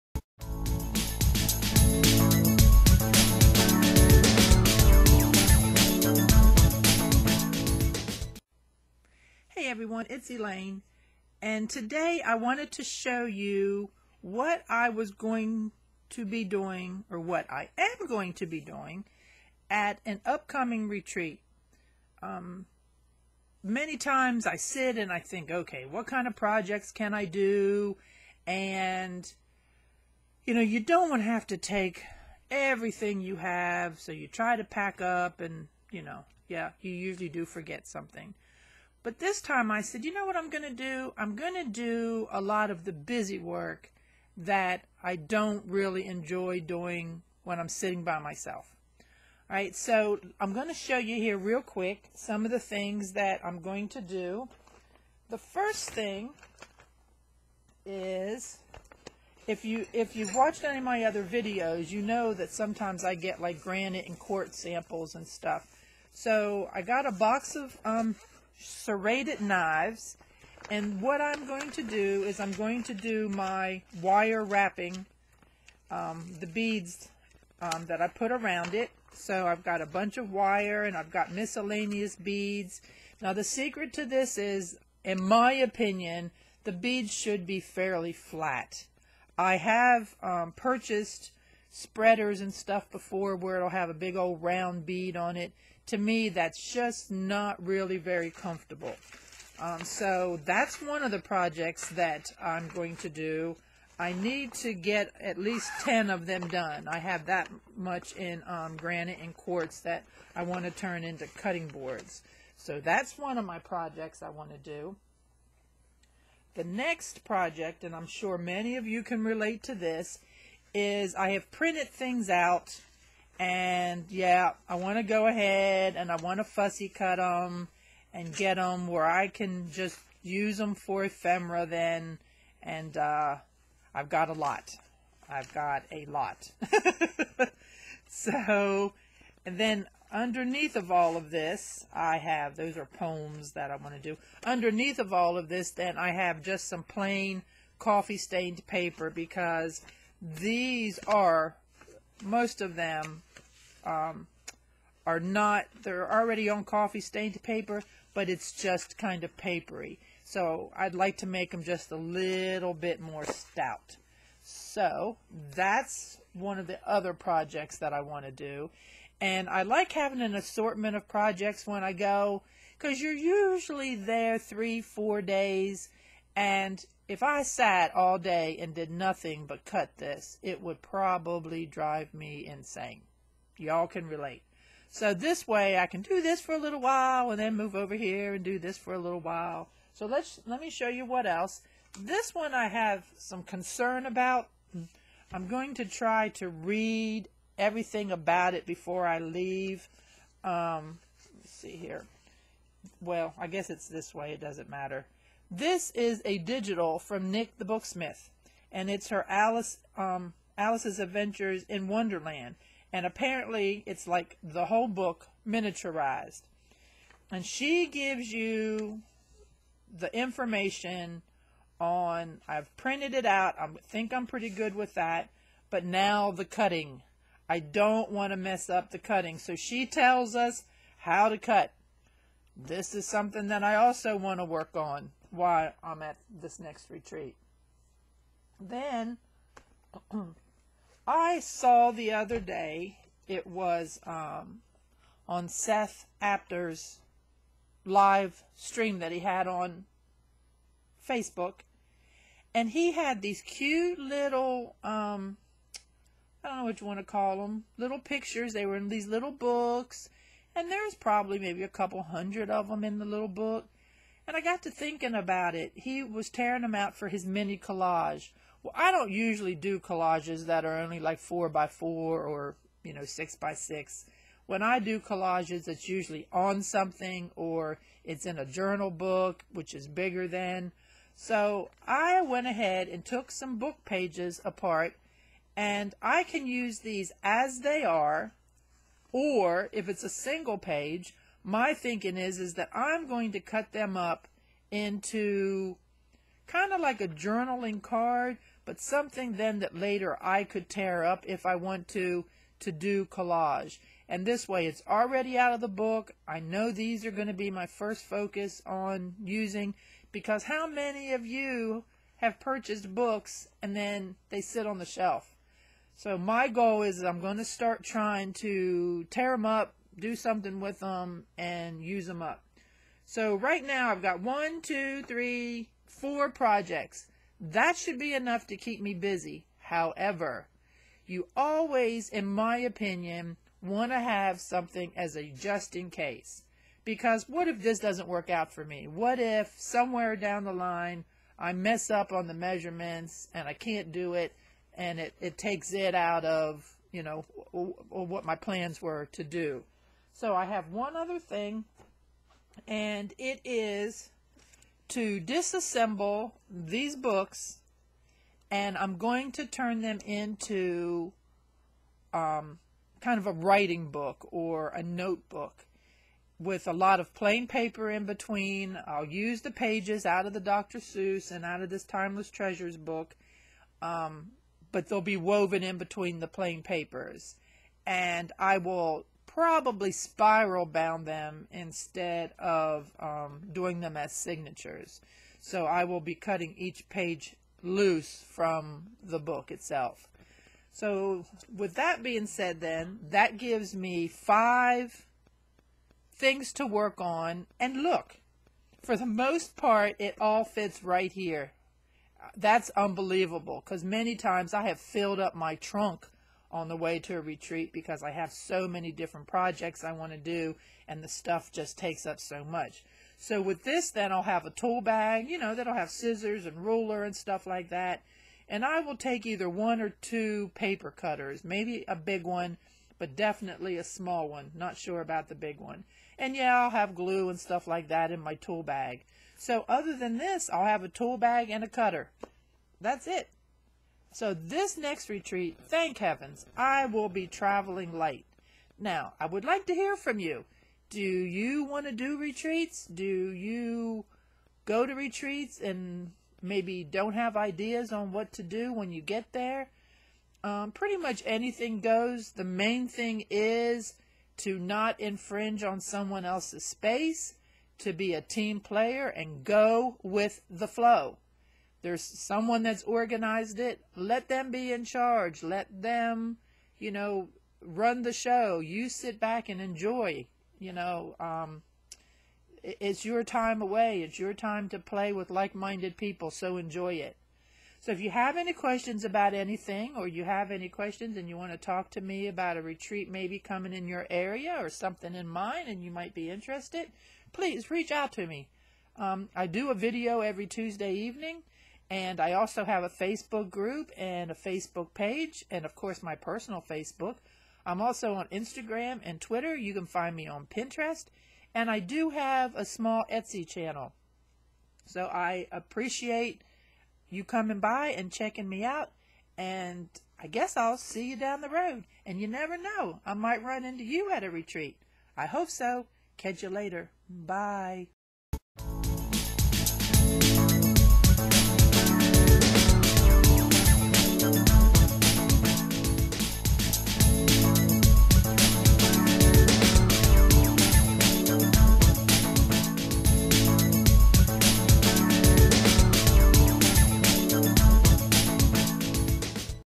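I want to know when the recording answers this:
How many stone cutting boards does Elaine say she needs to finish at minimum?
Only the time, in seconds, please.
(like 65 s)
105 s.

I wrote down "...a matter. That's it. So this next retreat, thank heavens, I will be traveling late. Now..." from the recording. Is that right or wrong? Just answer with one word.
wrong.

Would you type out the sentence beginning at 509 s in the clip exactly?
And I guess I'll see you down the road.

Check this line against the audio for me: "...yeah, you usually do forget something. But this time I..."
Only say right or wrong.
right.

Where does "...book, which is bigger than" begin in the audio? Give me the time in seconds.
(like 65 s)
278 s.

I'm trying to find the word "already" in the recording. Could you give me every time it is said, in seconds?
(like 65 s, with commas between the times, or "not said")
156 s, 304 s.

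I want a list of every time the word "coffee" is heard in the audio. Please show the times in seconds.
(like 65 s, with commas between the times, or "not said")
147 s, 156 s.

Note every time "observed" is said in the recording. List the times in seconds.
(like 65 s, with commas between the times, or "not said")
not said.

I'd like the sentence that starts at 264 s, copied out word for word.
And I got to thinking about it.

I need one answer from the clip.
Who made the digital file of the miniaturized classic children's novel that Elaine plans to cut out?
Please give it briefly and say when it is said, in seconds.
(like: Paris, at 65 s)
Nik the Booksmith, at 207 s.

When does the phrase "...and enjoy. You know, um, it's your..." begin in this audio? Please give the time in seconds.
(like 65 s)
469 s.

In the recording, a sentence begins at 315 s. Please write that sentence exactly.
So my goal is I'm going to start trying to tear them up, do something with them, and use them up.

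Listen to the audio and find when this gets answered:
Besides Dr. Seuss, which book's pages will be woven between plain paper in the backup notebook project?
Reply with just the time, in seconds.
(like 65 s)
371 s.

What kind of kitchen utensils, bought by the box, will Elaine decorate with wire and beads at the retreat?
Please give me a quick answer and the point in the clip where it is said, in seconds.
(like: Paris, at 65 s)
serrated knives, at 68 s.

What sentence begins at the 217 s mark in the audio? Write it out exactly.
And she gives you the information on, I've printed it out, I think I'm pretty good with that, but now the cutting.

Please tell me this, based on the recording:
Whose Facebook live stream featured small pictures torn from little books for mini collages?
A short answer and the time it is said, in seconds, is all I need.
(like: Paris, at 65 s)
Seth Apter, at 245 s.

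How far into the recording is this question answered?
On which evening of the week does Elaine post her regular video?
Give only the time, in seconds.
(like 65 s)
490 s.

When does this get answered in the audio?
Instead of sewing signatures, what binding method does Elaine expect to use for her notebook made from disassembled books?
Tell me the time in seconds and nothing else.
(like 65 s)
379 s.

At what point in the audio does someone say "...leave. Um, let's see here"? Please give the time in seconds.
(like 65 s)
199 s.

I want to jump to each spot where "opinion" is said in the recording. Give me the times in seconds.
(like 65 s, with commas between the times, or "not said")
85 s, 332 s.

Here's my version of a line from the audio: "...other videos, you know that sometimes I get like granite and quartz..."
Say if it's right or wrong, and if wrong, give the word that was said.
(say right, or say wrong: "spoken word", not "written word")
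right.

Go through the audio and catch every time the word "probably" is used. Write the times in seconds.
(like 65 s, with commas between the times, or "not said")
180 s, 260 s, 379 s.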